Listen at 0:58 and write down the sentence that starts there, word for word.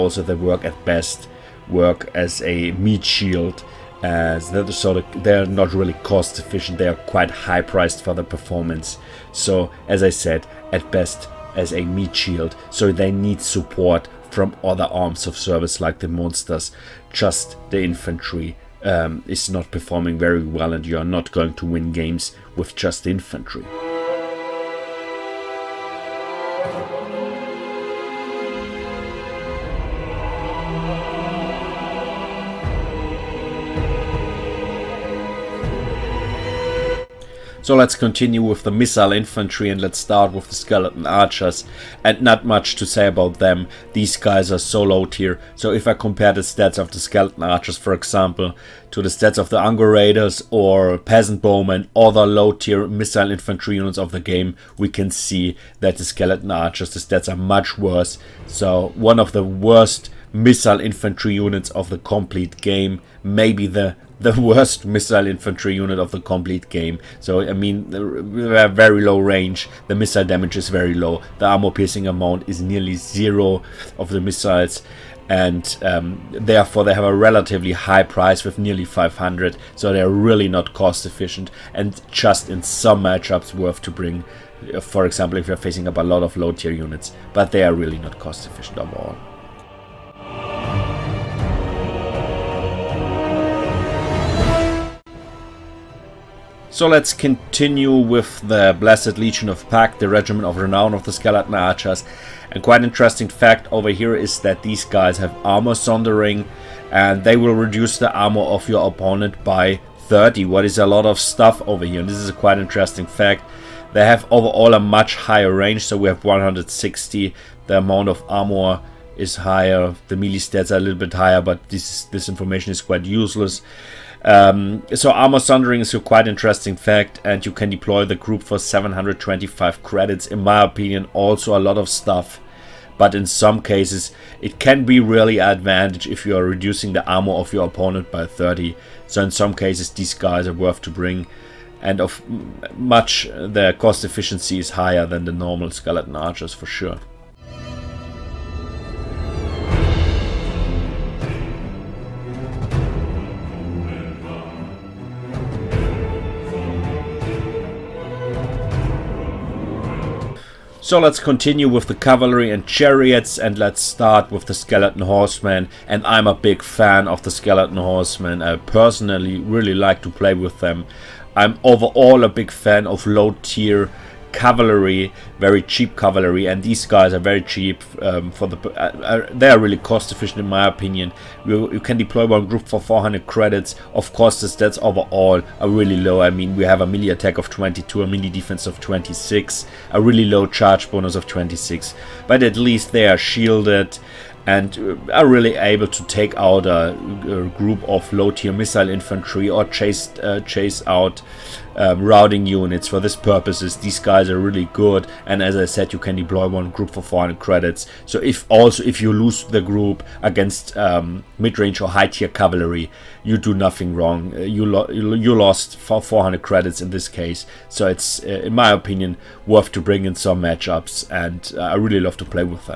So one of the worst missile infantry units of the complete game.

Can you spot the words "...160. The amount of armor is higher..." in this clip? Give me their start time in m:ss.
1:56.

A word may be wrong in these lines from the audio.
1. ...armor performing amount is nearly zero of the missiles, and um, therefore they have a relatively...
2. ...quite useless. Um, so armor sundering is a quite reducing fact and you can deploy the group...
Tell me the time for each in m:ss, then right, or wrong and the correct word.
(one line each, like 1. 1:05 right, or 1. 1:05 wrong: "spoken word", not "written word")
1. 1:11 wrong: "piercing", not "performing"
2. 2:02 wrong: "interesting", not "reducing".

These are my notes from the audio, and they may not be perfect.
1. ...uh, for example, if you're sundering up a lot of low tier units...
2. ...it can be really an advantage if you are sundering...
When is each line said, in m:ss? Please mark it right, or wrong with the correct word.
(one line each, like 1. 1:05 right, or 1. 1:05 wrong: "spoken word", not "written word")
1. 1:24 wrong: "facing", not "sundering"
2. 2:14 wrong: "reducing", not "sundering".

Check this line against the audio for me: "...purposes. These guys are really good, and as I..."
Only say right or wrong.
right.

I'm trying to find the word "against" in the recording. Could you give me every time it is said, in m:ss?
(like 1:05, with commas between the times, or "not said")
3:30.